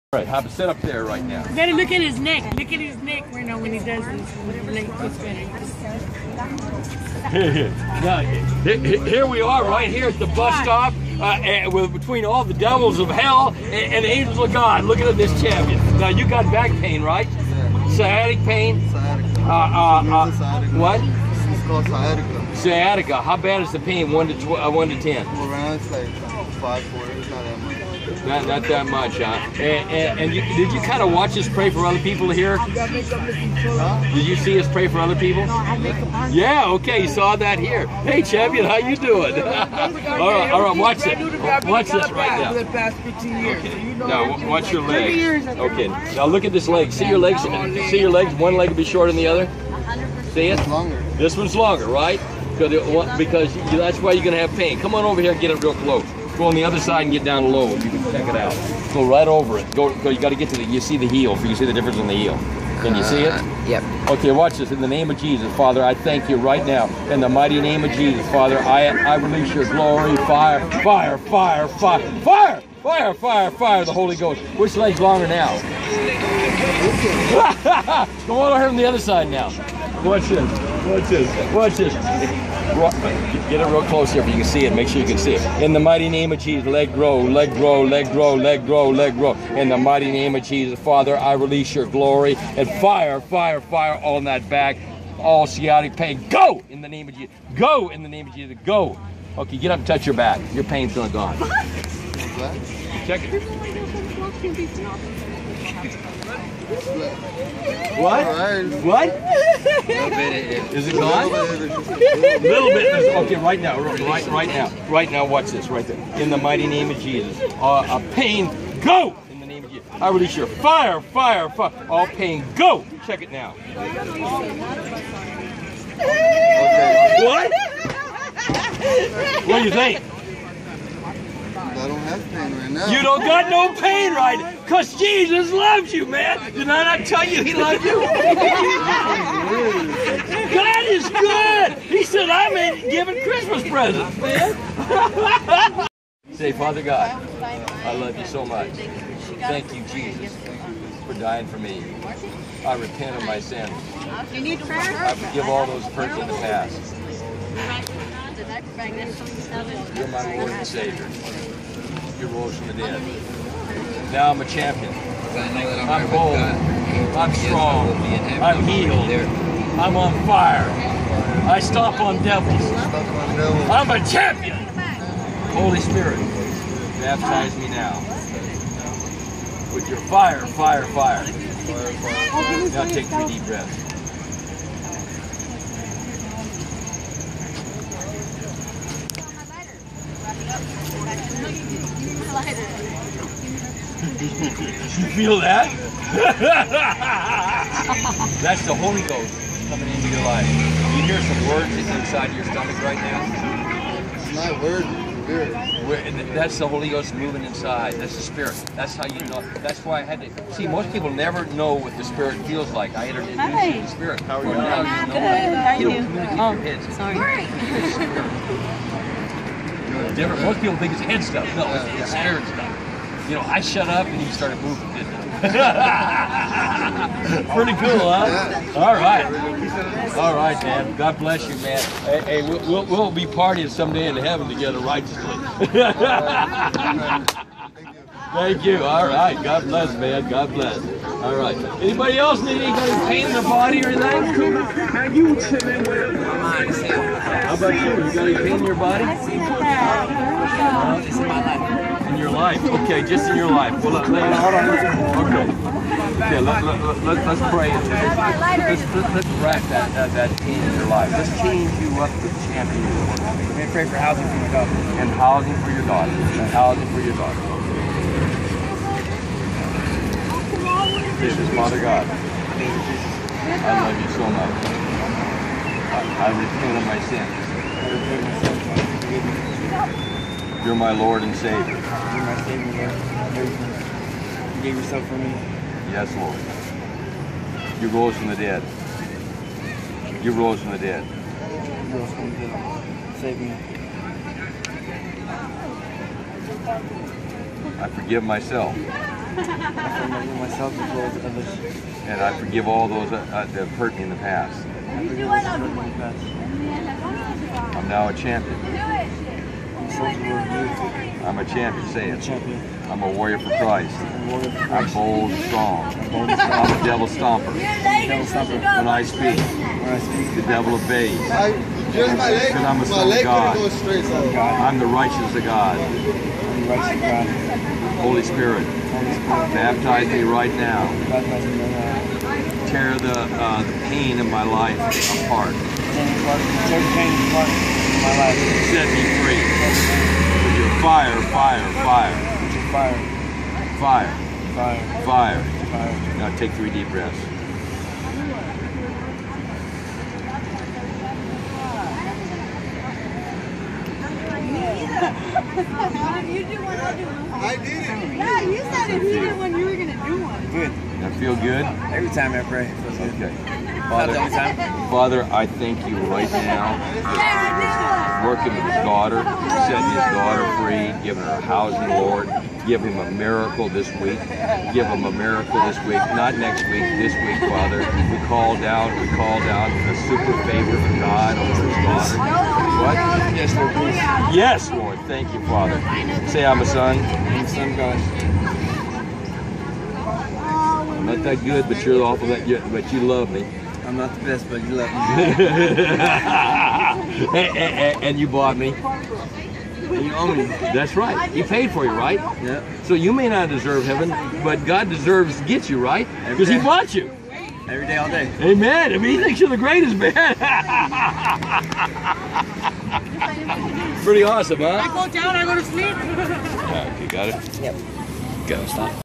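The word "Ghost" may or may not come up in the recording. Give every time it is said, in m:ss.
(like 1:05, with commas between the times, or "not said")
1:14, 3:19, 3:26.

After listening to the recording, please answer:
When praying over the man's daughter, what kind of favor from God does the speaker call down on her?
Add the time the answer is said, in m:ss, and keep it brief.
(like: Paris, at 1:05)
super favor, at 6:20.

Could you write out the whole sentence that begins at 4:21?
Let's change you up to champion.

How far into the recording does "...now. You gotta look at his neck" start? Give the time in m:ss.
0:01.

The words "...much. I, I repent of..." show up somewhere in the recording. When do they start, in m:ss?
4:34.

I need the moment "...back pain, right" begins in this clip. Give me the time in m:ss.
0:16.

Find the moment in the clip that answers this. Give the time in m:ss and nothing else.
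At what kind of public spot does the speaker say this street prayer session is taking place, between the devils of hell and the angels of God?
0:10.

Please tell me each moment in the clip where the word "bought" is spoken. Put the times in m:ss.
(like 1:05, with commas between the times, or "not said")
6:38, 6:46.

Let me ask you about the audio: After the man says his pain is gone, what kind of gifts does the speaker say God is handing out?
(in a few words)
Christmas presents.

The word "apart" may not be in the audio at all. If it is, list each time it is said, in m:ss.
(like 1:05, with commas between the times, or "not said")
5:35.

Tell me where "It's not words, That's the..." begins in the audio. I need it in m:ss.
3:24.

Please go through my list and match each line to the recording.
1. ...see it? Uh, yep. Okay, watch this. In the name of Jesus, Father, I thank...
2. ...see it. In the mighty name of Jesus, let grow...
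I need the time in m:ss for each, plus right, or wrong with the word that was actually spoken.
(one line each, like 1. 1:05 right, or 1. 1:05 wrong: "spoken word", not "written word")
1. 1:03 right
2. 1:25 right.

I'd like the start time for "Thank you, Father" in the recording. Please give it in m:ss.
6:25.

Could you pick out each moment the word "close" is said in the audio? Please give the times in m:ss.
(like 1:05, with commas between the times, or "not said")
0:55, 1:23.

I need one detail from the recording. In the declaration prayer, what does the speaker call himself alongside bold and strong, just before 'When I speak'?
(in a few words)
devil stomper.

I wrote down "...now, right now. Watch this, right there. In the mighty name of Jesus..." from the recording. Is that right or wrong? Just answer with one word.
right.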